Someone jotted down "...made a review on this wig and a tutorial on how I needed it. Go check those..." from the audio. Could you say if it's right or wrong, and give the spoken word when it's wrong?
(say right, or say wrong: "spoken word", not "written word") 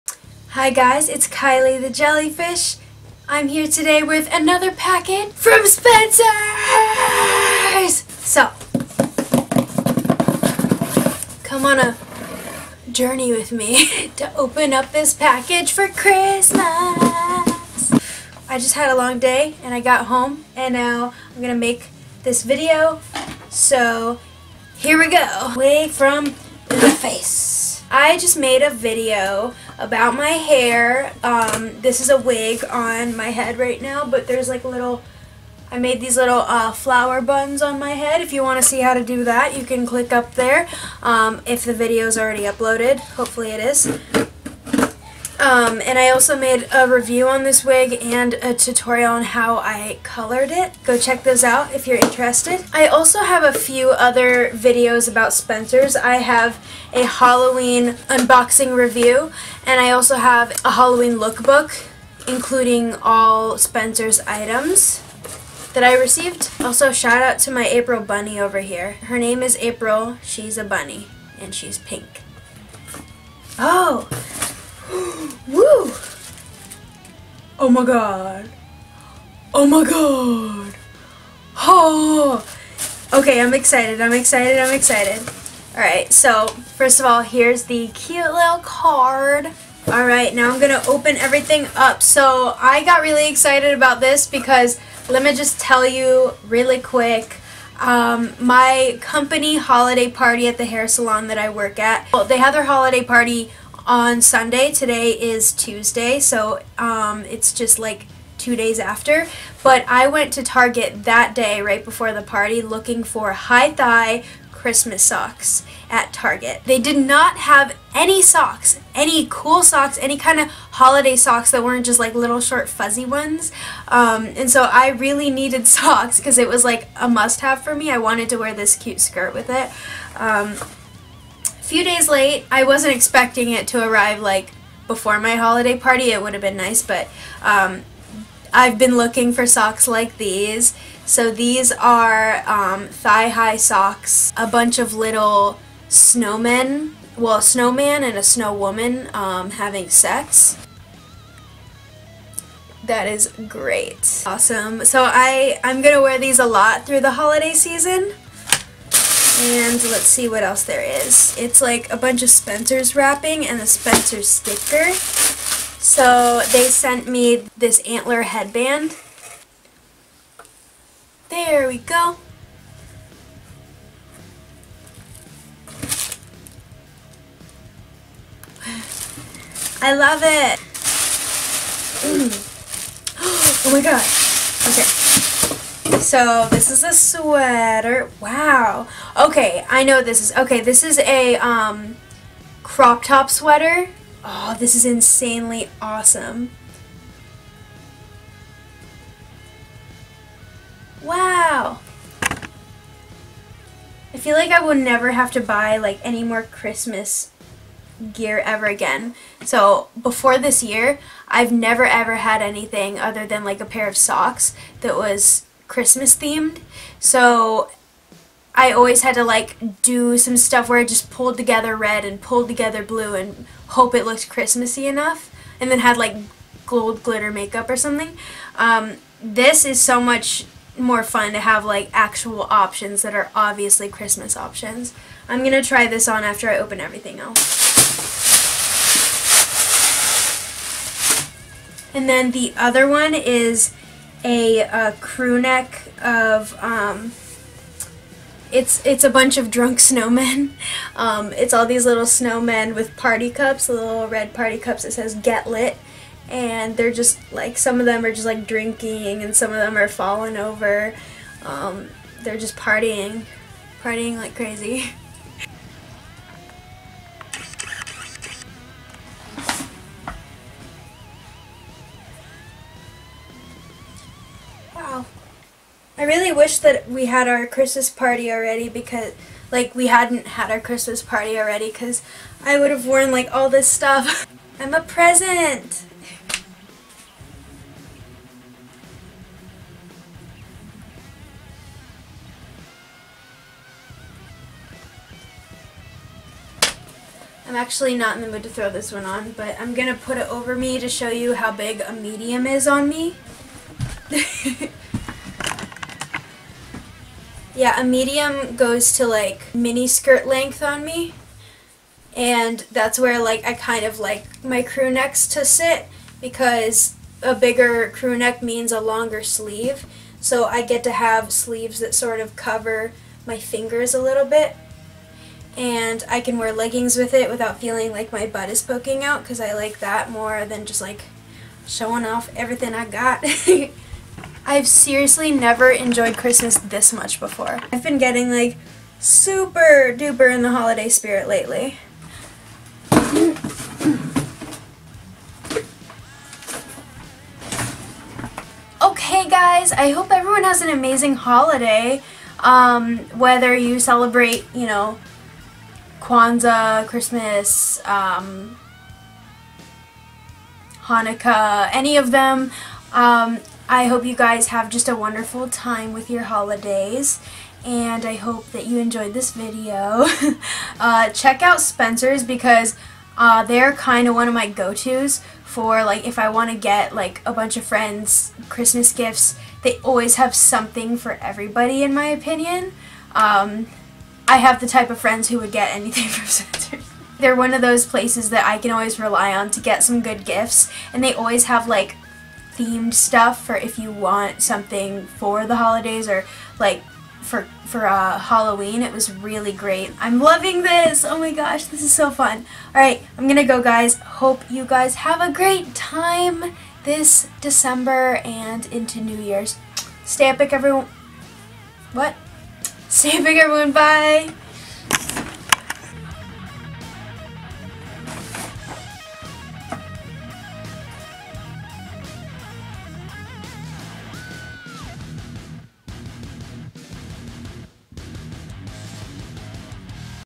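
wrong: "colored", not "needed".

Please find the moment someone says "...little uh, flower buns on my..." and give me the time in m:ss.
0:36.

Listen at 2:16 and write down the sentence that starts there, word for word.
It would have been nice, but um, I've been looking for socks like these.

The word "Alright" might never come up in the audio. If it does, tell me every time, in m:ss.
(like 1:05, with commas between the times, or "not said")
1:25, 1:29.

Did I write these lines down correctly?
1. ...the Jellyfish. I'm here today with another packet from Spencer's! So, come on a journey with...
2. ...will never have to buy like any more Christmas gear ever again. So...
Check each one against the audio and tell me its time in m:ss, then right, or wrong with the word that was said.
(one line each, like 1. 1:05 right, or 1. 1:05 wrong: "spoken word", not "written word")
1. 0:01 right
2. 3:24 right.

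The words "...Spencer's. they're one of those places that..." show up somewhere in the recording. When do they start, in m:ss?
6:26.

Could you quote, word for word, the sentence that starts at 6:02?
Um, I hope you guys have just a wonderful time with your holidays and I hope that you enjoyed this video.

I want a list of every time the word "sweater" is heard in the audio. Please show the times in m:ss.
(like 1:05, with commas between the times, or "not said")
3:06, 3:13.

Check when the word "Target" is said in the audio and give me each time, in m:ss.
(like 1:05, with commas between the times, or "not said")
1:50, 1:56.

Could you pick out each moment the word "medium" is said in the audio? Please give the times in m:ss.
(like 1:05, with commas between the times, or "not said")
5:01, 5:07.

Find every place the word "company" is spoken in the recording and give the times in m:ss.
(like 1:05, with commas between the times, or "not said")
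1:39.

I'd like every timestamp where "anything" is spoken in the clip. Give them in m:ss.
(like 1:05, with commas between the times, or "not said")
3:32, 6:25.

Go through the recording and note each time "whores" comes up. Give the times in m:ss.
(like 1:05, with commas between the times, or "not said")
not said.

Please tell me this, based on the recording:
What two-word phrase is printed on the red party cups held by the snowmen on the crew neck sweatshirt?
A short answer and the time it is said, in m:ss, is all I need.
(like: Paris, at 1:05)
Get Lit, at 4:15.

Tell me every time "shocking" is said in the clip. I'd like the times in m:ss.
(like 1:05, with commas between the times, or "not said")
not said.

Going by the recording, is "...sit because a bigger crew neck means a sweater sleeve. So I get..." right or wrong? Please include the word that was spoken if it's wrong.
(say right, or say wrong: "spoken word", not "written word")
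wrong: "longer", not "sweater".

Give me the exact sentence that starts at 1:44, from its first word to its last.
Today is Tuesday, so um, it's just like two days after.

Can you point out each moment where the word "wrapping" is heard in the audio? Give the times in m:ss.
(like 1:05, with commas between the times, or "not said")
2:42.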